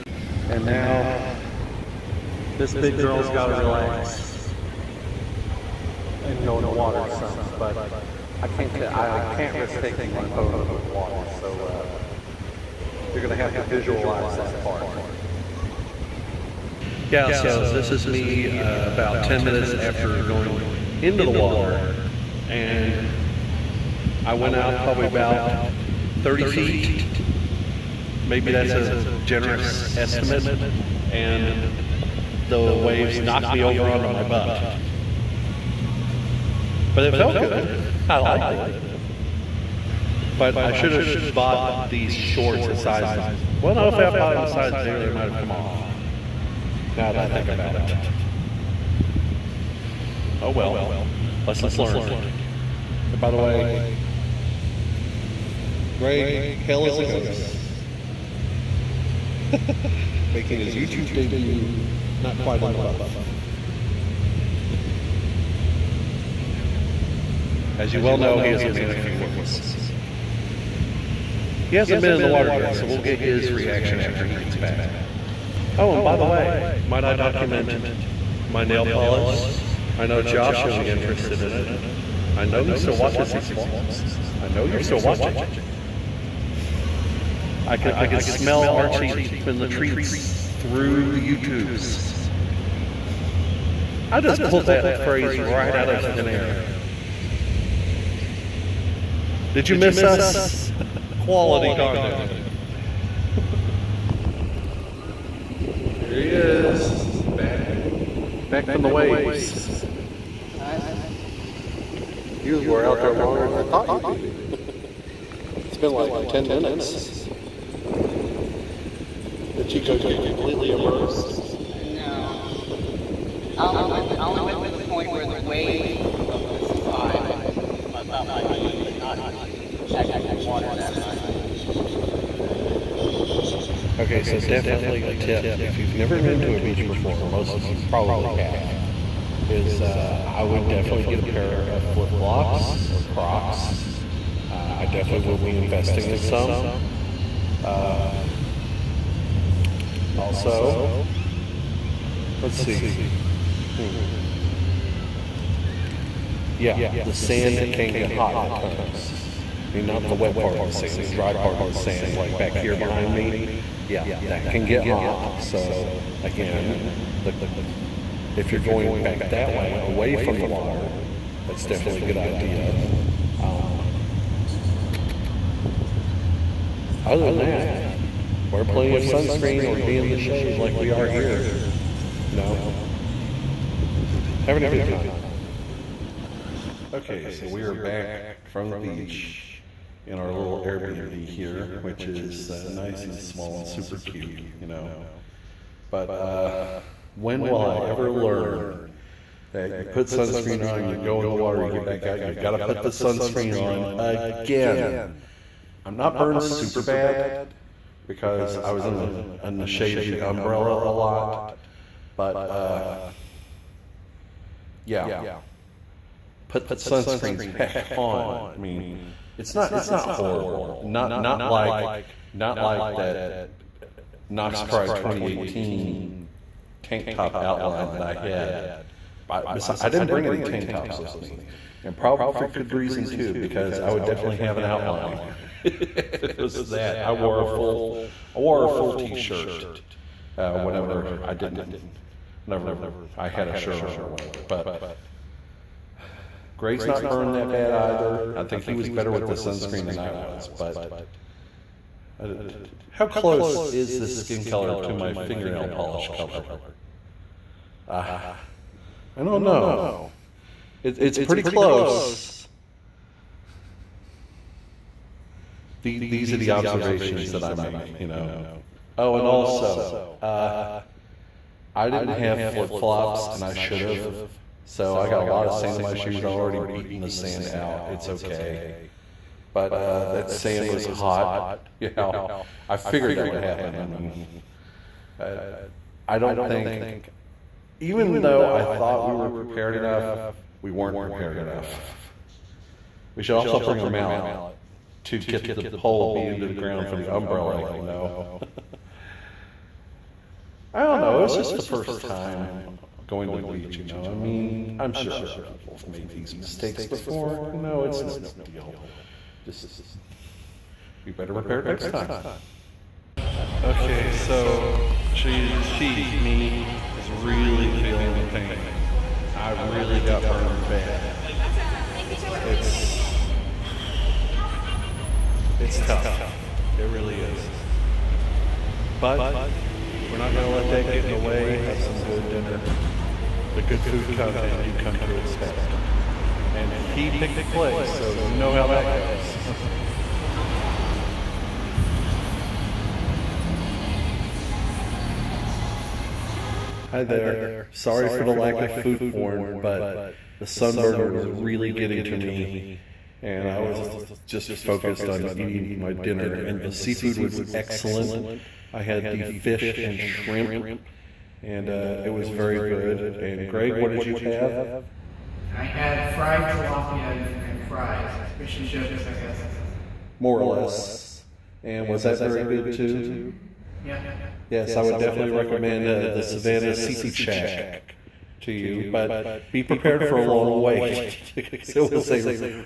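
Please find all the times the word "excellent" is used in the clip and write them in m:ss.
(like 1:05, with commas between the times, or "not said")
5:57.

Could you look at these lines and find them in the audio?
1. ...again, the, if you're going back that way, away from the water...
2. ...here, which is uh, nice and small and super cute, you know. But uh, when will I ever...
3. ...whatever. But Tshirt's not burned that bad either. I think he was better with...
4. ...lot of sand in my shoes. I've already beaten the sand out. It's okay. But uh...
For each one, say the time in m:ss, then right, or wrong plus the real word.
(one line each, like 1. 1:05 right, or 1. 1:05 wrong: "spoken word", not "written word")
1. 2:46 right
2. 3:11 right
3. 4:04 wrong: "Greg", not "Tshirt"
4. 4:35 right.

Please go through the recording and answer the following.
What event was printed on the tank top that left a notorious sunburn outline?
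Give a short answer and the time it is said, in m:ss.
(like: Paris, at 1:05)
Knox Pride 2018, at 3:44.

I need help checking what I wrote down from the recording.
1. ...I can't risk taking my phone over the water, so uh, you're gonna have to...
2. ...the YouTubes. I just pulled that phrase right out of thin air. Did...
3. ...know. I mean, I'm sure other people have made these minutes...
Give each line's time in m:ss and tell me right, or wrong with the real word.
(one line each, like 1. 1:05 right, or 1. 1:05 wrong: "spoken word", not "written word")
1. 0:09 right
2. 1:31 right
3. 5:03 wrong: "mistakes", not "minutes".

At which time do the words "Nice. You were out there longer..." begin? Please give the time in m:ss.
1:50.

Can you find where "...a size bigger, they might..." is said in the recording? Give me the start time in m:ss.
0:44.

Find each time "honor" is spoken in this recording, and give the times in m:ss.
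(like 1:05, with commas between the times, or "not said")
not said.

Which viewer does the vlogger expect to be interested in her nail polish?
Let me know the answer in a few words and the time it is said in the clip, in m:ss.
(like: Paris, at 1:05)
Josh, at 1:20.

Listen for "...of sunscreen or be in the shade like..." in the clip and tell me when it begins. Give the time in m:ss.
2:58.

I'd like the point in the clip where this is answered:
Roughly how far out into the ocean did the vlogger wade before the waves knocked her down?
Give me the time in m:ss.
0:26.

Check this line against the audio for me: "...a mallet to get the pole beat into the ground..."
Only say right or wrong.
right.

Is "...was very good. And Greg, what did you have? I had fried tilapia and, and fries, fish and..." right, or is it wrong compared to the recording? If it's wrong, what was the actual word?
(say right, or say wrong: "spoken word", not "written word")
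right.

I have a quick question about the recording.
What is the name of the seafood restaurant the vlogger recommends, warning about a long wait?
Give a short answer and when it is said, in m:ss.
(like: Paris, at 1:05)
Savannah Seafood Shack, at 6:16.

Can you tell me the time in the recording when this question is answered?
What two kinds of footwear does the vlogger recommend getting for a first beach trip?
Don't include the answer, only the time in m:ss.
2:21.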